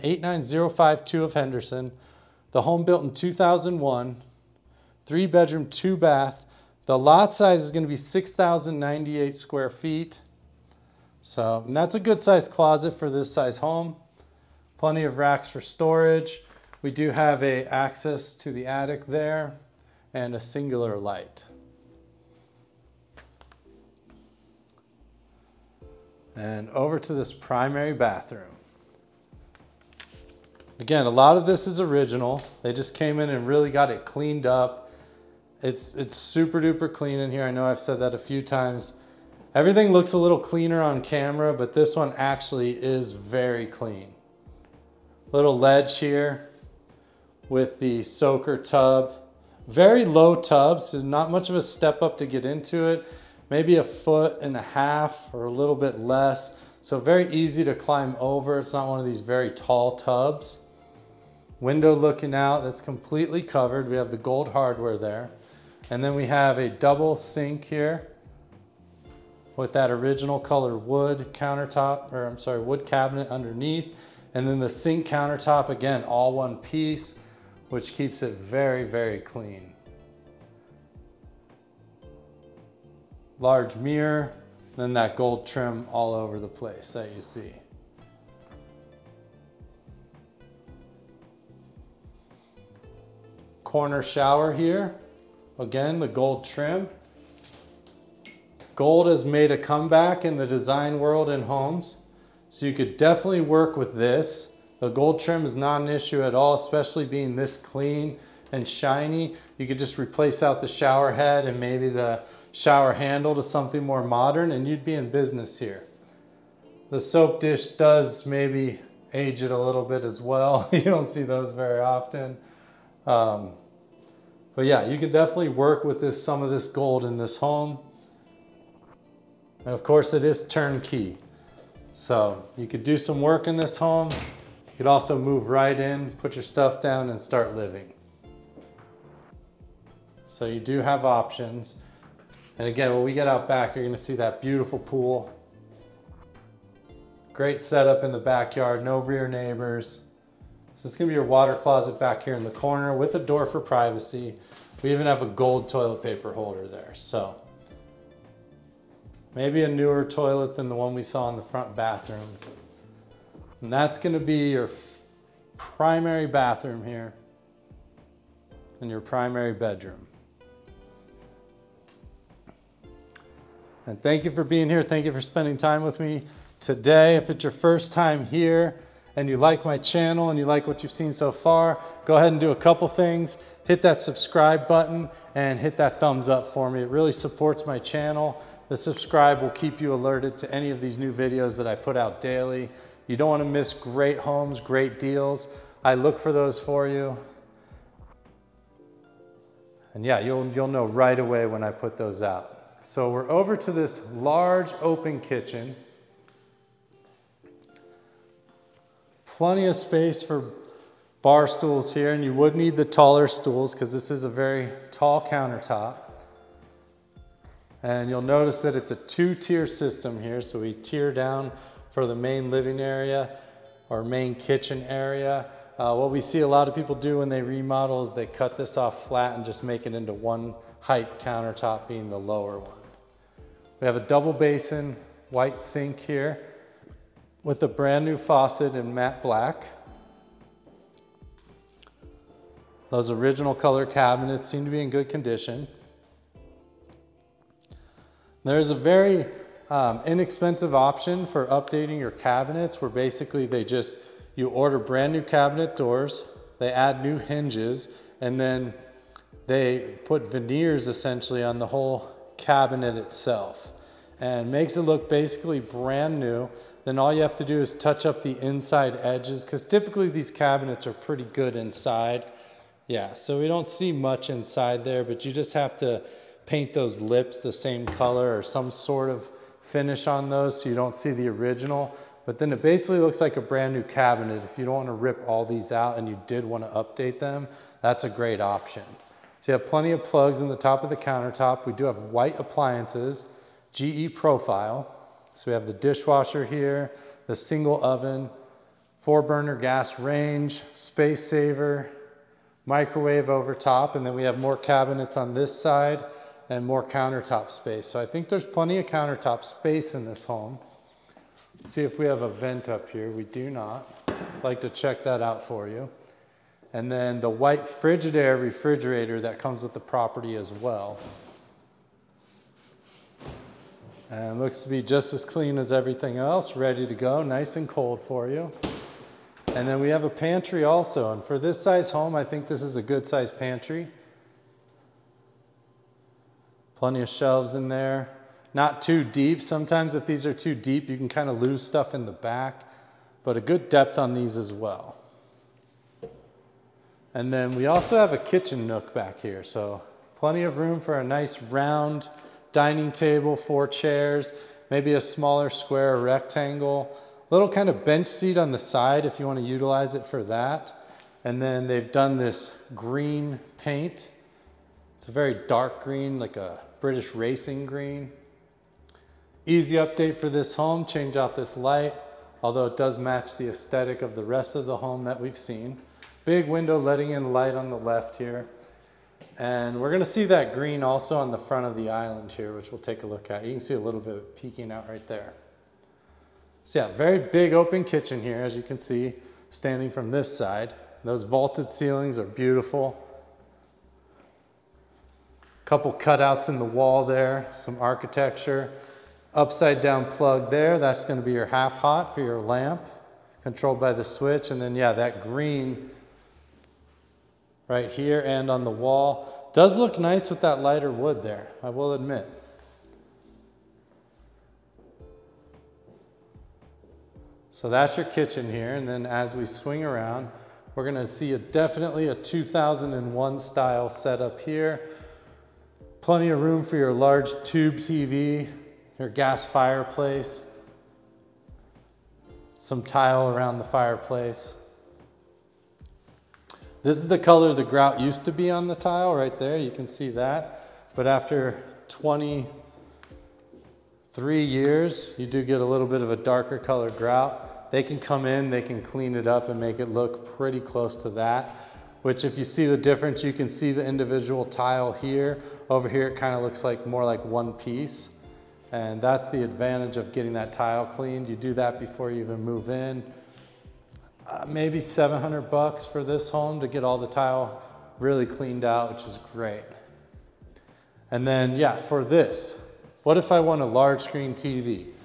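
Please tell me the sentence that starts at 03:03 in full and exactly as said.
Hit that subscribe button and hit that thumbs up for me.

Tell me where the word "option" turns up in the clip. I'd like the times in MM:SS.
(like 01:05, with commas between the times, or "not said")
02:21, 04:10, 04:48.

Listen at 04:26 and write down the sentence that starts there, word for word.
Then all you have to do is touch up the inside edges because typically these cabinets are pretty good inside.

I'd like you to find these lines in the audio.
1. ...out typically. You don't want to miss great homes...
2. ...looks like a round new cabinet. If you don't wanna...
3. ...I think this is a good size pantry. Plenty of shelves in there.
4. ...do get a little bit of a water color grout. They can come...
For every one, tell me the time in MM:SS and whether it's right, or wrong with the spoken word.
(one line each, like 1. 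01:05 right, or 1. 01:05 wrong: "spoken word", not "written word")
1. 03:11 wrong: "daily", not "typically"
2. 04:42 wrong: "brand", not "round"
3. 05:32 right
4. 07:25 wrong: "darker", not "water".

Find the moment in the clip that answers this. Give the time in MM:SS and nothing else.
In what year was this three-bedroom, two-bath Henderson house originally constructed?
00:02.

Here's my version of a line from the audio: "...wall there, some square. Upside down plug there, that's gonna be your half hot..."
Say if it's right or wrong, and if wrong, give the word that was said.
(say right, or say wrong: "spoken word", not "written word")
wrong: "architecture", not "square".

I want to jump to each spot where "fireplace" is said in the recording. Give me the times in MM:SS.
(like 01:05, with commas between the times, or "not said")
07:09, 07:13.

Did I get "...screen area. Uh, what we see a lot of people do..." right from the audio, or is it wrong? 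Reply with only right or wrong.
wrong.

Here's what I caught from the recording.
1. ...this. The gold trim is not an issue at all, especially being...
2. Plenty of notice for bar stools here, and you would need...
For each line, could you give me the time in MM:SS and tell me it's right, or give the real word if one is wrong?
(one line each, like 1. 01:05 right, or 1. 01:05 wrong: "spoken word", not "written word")
1. 01:43 right
2. 03:29 wrong: "space", not "notice".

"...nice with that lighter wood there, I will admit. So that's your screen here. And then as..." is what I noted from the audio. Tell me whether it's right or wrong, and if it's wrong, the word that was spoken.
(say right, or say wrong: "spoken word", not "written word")
wrong: "kitchen", not "screen".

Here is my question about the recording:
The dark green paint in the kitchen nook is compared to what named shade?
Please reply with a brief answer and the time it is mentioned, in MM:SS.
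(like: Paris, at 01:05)
British racing green, at 06:06.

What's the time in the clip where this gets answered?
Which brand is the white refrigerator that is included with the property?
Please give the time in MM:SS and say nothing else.
05:17.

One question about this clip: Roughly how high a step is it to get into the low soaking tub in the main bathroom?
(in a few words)
a foot and a half.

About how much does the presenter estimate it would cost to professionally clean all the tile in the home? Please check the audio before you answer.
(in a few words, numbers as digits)
$700.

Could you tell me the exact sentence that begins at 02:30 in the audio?
So it's gonna be your water closet back here in the corner with a door for privacy.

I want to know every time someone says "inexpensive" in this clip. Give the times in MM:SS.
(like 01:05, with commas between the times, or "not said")
04:10.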